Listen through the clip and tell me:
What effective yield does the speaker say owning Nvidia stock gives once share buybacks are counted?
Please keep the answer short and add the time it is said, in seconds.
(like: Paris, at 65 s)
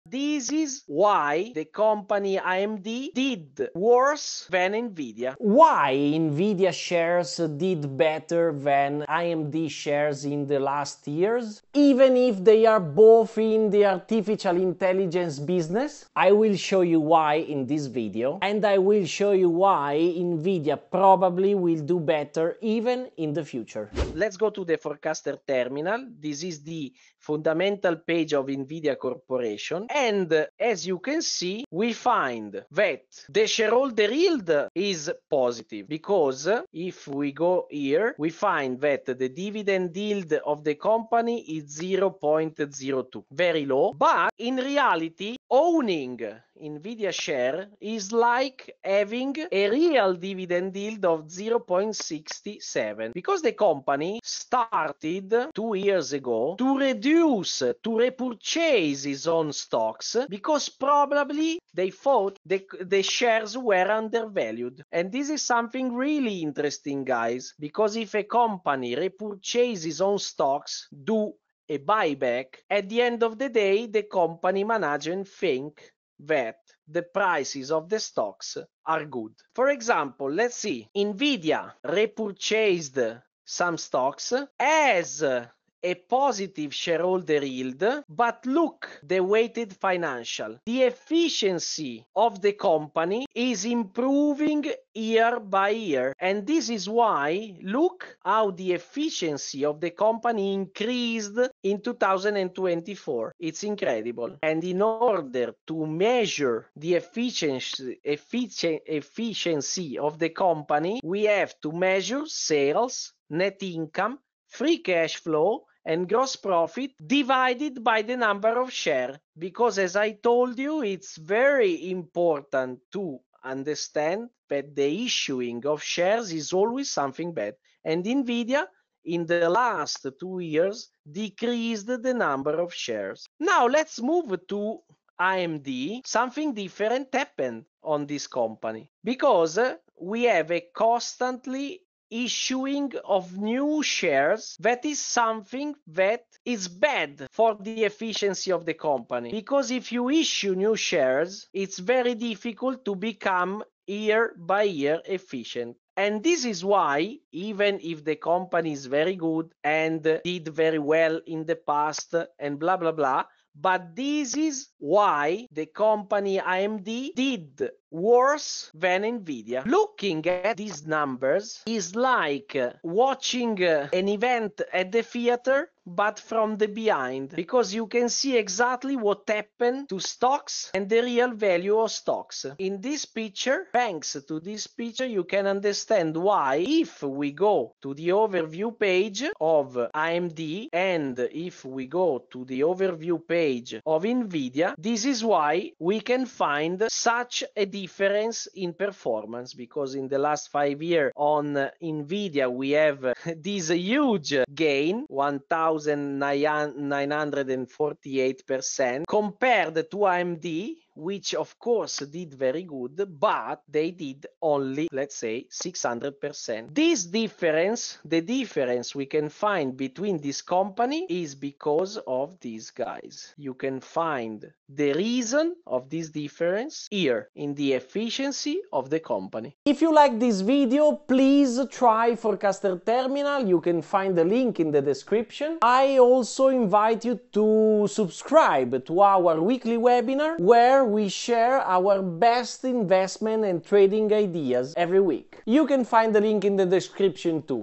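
0.67, at 51 s.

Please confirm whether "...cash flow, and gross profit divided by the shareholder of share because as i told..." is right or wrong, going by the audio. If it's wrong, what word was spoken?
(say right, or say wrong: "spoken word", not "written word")
wrong: "number", not "shareholder".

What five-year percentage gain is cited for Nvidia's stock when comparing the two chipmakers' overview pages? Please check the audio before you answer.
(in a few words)
1948%.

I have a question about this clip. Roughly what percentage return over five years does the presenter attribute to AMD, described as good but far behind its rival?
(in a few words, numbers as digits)
600%.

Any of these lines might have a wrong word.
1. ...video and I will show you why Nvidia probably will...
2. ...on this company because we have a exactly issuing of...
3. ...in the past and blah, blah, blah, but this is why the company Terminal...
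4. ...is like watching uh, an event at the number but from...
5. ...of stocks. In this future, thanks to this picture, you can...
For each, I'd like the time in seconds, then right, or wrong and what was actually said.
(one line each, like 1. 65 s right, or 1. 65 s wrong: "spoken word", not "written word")
1. 17 s right
2. 137 s wrong: "constantly", not "exactly"
3. 161 s wrong: "AMD", not "Terminal"
4. 171 s wrong: "theater", not "number"
5. 181 s wrong: "picture", not "future".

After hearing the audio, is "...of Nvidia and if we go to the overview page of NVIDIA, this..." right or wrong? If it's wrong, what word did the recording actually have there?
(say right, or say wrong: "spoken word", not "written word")
wrong: "AMD", not "Nvidia".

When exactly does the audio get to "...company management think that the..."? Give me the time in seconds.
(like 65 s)
74 s.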